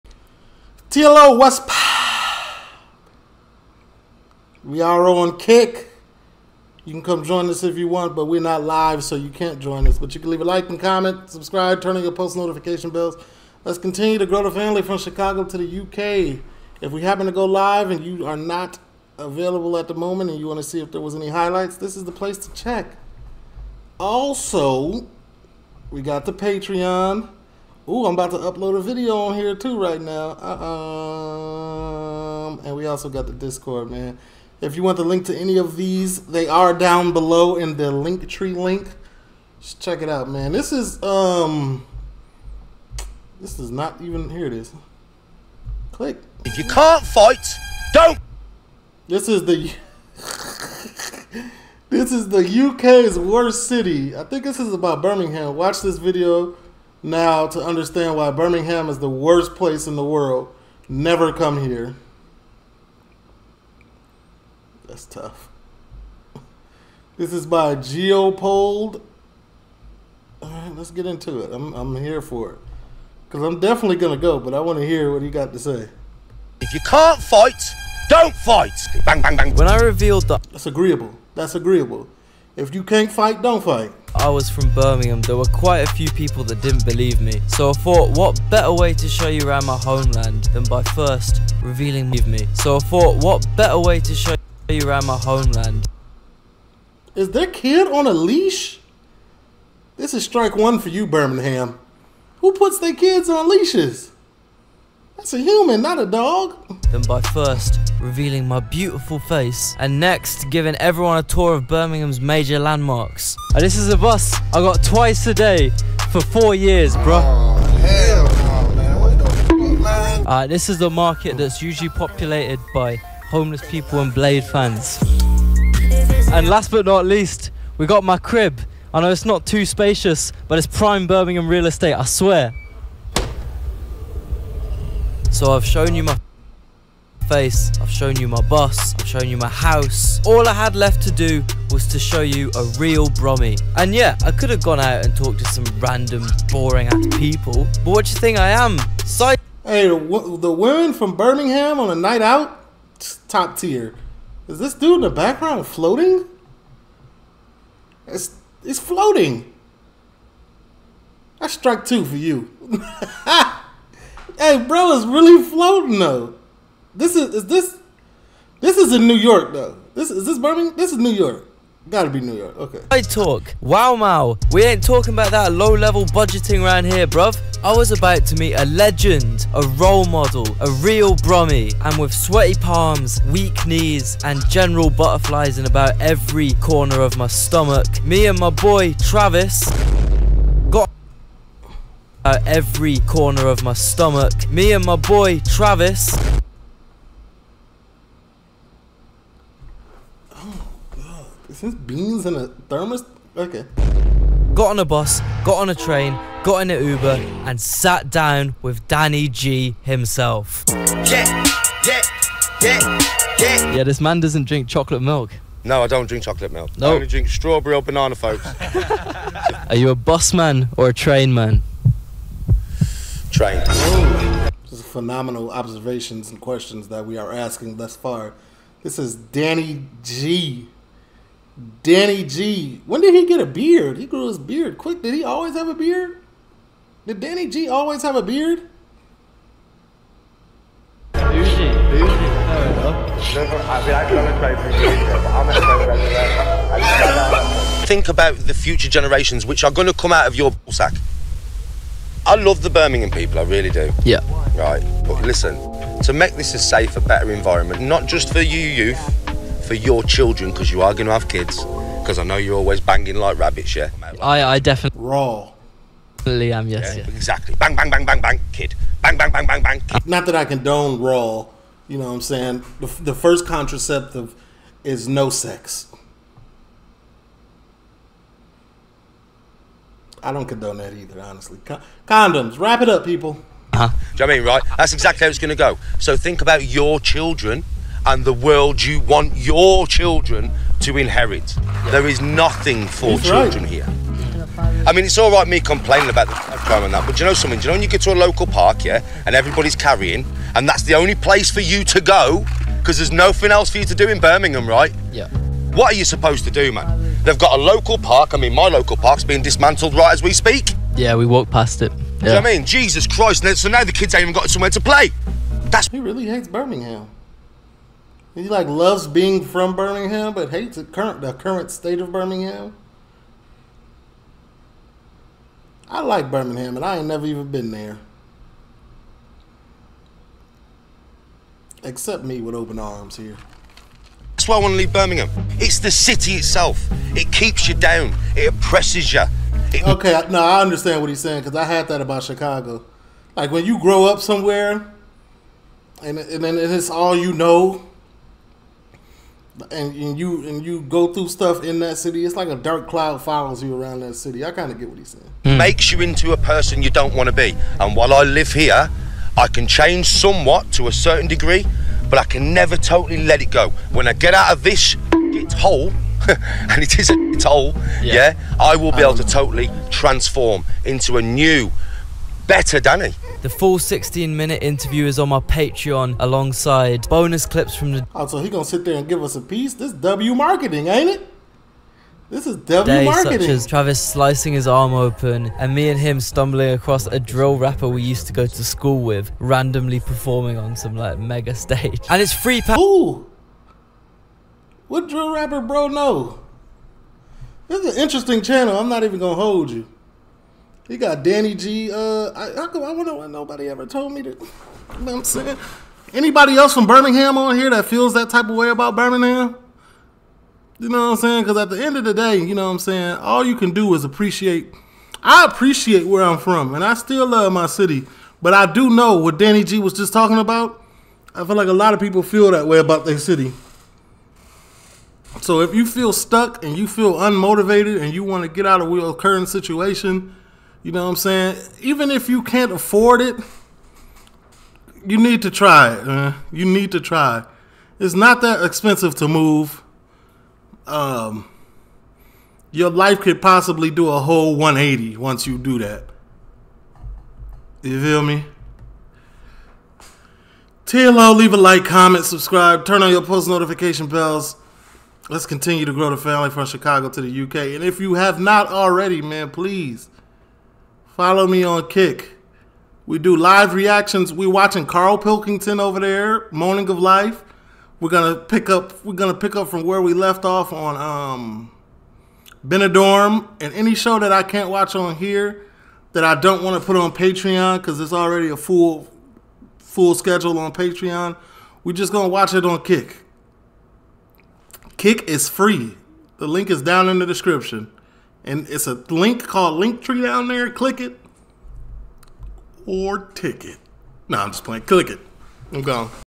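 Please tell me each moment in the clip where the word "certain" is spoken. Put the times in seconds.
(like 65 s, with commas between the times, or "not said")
360 s.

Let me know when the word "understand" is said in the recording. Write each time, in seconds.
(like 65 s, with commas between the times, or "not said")
57 s, 340 s.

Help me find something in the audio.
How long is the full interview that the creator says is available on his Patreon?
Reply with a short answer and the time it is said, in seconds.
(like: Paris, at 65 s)
16 minutes, at 373 s.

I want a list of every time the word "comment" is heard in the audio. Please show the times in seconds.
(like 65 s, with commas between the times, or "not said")
10 s, 451 s.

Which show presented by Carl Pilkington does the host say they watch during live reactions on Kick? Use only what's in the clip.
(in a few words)
Moaning of Life.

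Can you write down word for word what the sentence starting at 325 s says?
I like Birmingham, and I ain't never even been there.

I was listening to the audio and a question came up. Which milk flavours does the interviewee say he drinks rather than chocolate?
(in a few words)
Strawberry or banana.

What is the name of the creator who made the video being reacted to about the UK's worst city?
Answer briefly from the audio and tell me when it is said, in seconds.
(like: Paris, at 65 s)
Geopold, at 67 s.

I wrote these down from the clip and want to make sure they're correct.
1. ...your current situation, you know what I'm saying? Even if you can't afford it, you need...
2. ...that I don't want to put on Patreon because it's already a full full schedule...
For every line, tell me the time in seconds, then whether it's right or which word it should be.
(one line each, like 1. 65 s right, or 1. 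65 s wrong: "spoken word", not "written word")
1. 428 s right
2. 476 s right.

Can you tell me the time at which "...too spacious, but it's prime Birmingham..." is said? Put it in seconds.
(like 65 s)
129 s.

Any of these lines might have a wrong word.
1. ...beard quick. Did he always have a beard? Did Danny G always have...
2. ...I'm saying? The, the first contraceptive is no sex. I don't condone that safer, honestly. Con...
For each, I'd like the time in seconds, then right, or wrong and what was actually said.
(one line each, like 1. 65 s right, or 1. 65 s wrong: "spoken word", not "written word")
1. 234 s right
2. 272 s wrong: "either", not "safer".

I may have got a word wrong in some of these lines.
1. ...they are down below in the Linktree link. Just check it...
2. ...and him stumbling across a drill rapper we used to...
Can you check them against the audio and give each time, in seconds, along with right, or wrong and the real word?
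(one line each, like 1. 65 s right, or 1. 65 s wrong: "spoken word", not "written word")
1. 36 s right
2. 385 s right.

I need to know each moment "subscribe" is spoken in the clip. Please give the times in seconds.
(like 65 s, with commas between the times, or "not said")
11 s, 452 s.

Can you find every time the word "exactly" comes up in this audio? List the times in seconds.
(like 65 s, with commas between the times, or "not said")
267 s, 284 s.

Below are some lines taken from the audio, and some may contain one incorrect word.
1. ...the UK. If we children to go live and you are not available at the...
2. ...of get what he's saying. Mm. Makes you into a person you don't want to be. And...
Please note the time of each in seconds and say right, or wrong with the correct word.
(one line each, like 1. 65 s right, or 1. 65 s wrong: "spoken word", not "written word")
1. 15 s wrong: "happen", not "children"
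2. 354 s right.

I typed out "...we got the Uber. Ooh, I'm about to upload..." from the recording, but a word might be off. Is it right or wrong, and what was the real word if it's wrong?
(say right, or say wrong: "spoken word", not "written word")
wrong: "Patreon", not "Uber".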